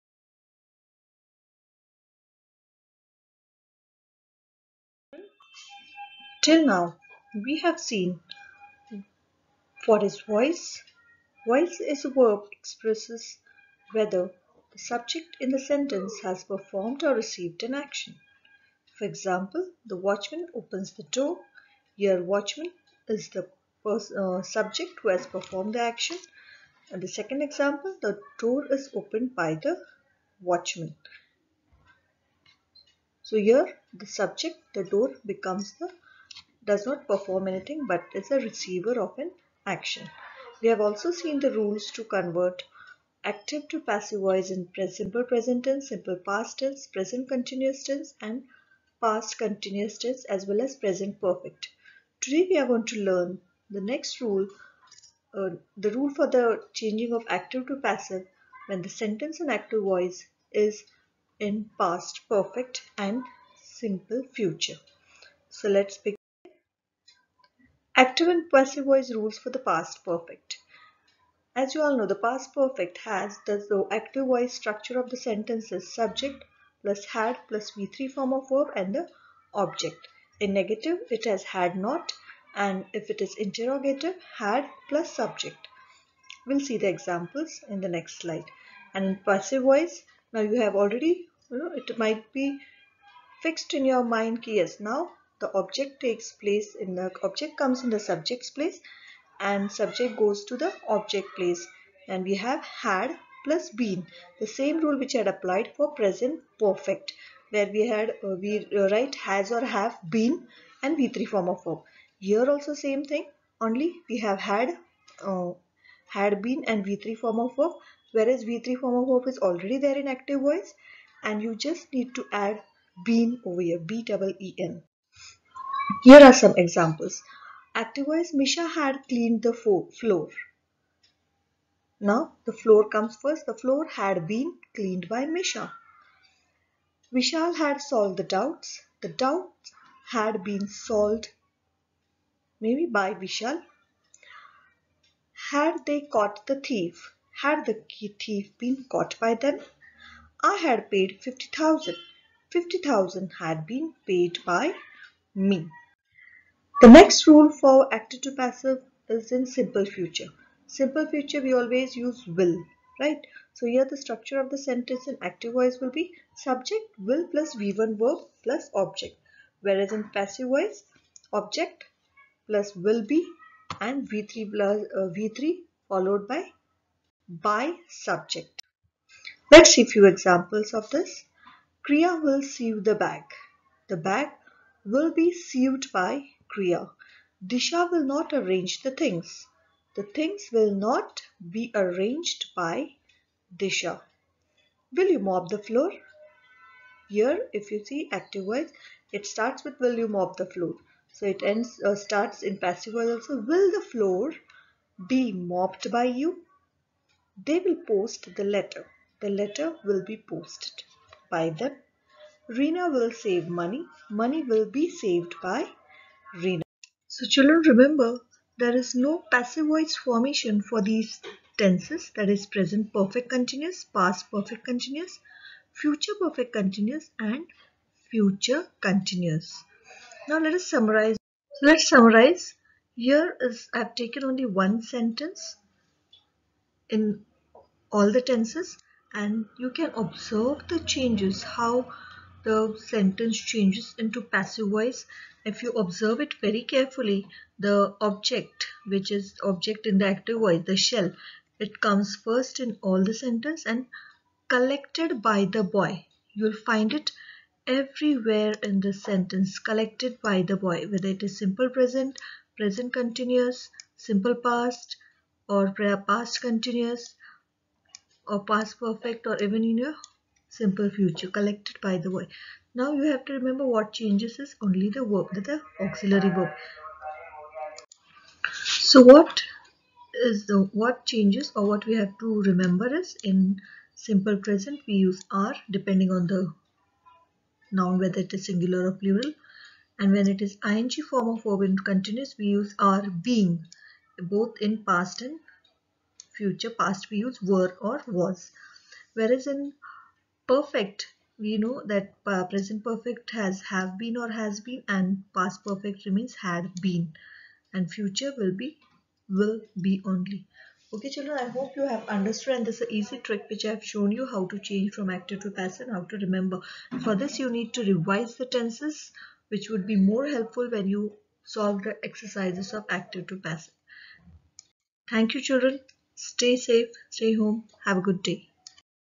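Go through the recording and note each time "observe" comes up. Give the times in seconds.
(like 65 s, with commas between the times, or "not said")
239 s, 245 s.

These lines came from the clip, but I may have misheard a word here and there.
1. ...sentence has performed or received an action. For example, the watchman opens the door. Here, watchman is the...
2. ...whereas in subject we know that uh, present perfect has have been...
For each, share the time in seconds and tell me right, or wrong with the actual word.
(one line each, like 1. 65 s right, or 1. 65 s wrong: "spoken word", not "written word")
1. 15 s right
2. 299 s wrong: "perfect", not "subject".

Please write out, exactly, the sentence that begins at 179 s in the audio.
Let's see a few examples of this.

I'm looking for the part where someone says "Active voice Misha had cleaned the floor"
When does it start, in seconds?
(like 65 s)
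127 s.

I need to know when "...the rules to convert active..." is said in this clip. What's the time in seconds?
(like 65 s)
41 s.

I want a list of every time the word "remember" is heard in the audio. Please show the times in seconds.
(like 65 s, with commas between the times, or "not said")
217 s, 273 s, 282 s, 316 s.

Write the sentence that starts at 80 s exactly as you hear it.
In negative, it has had not and if it is interrogative, had plus subject.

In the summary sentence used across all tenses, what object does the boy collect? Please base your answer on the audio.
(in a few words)
the shell.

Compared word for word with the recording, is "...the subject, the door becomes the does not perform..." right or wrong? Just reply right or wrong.
right.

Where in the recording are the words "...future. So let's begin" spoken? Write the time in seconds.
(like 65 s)
64 s.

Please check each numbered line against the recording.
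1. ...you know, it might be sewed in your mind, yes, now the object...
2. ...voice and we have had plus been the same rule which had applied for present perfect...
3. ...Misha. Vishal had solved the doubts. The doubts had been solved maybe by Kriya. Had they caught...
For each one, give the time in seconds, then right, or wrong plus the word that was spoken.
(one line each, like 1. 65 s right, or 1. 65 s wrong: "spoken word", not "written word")
1. 91 s wrong: "fixed", not "sewed"
2. 101 s wrong: "place", not "voice"
3. 135 s wrong: "Vishal", not "Kriya".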